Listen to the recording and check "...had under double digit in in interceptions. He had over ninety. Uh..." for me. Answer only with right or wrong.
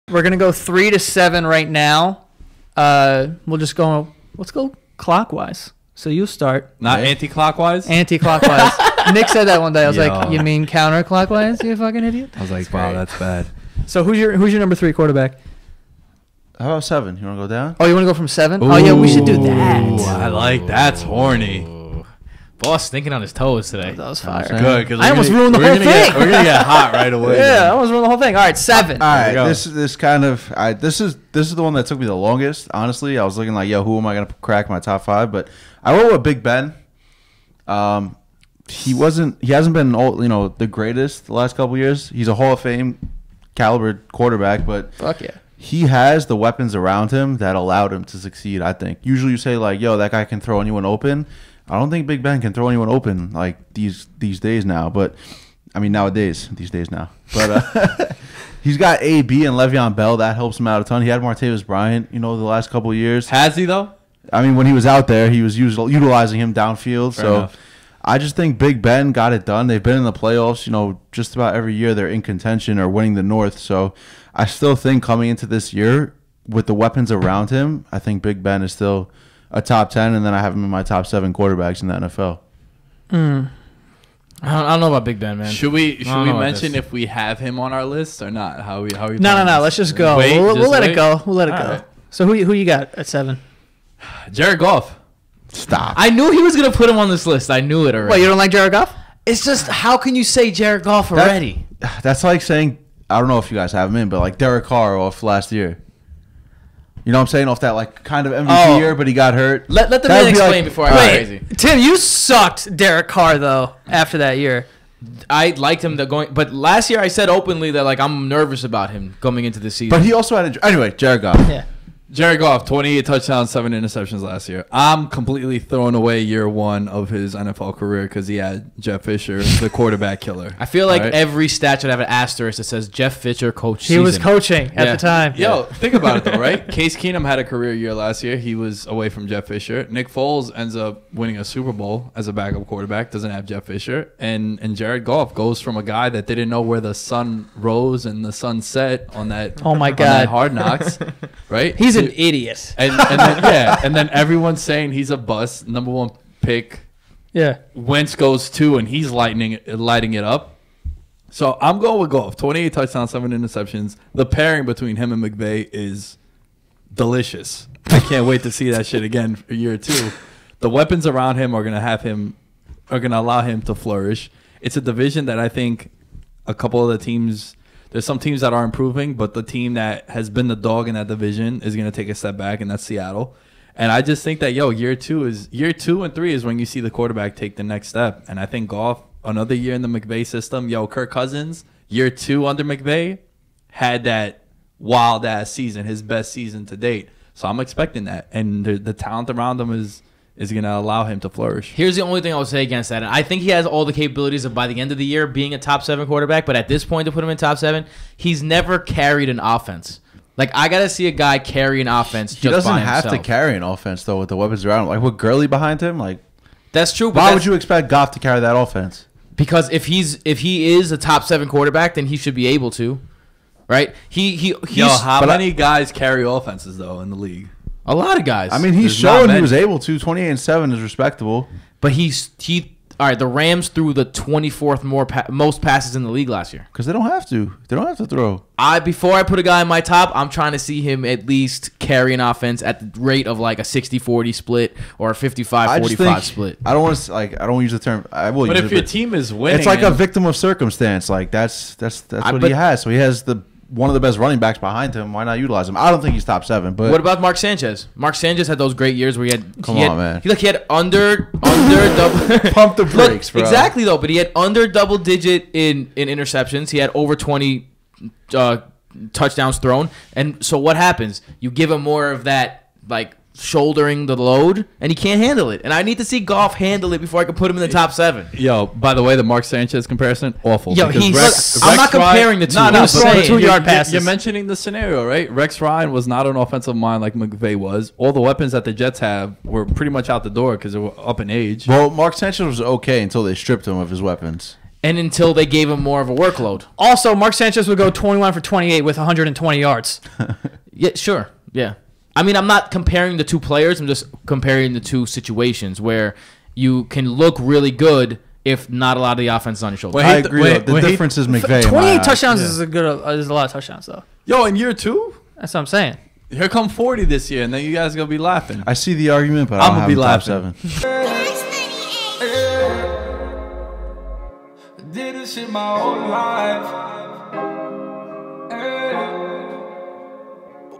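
wrong.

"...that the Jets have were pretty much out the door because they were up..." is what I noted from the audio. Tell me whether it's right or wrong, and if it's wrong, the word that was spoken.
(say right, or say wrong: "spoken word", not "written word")
right.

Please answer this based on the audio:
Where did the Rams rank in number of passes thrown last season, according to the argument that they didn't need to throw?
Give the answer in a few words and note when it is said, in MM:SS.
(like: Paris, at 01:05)
24th, at 03:54.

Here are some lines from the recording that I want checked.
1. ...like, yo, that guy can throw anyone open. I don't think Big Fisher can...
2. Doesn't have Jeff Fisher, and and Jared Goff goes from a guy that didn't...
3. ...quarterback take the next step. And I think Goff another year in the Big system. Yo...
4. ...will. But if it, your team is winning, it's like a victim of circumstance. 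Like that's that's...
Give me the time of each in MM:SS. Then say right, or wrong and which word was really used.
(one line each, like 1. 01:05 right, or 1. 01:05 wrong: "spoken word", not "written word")
1. 00:49 wrong: "Ben", not "Fisher"
2. 02:23 right
3. 03:06 wrong: "McVay", not "Big"
4. 04:08 right.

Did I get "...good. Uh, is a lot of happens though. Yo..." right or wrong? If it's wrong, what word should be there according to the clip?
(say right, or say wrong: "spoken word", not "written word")
wrong: "touchdowns", not "happens".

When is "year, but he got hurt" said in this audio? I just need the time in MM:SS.
01:48.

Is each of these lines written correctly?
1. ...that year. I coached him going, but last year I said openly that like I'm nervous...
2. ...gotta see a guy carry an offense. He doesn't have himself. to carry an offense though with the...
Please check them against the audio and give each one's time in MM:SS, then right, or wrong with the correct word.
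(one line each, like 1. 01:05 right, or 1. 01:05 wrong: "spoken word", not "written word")
1. 01:54 wrong: "liked", not "coached"
2. 03:30 right.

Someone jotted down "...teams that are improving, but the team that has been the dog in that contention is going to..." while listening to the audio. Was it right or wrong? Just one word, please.
wrong.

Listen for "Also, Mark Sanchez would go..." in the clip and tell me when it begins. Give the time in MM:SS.
04:56.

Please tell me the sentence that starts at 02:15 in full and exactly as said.
Yo, think about it though, right?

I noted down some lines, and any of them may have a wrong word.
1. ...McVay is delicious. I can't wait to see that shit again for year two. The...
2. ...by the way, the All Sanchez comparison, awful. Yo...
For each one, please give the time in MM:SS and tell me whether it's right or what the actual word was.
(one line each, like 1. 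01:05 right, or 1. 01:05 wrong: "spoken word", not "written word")
1. 02:45 right
2. 04:38 wrong: "Mark", not "All".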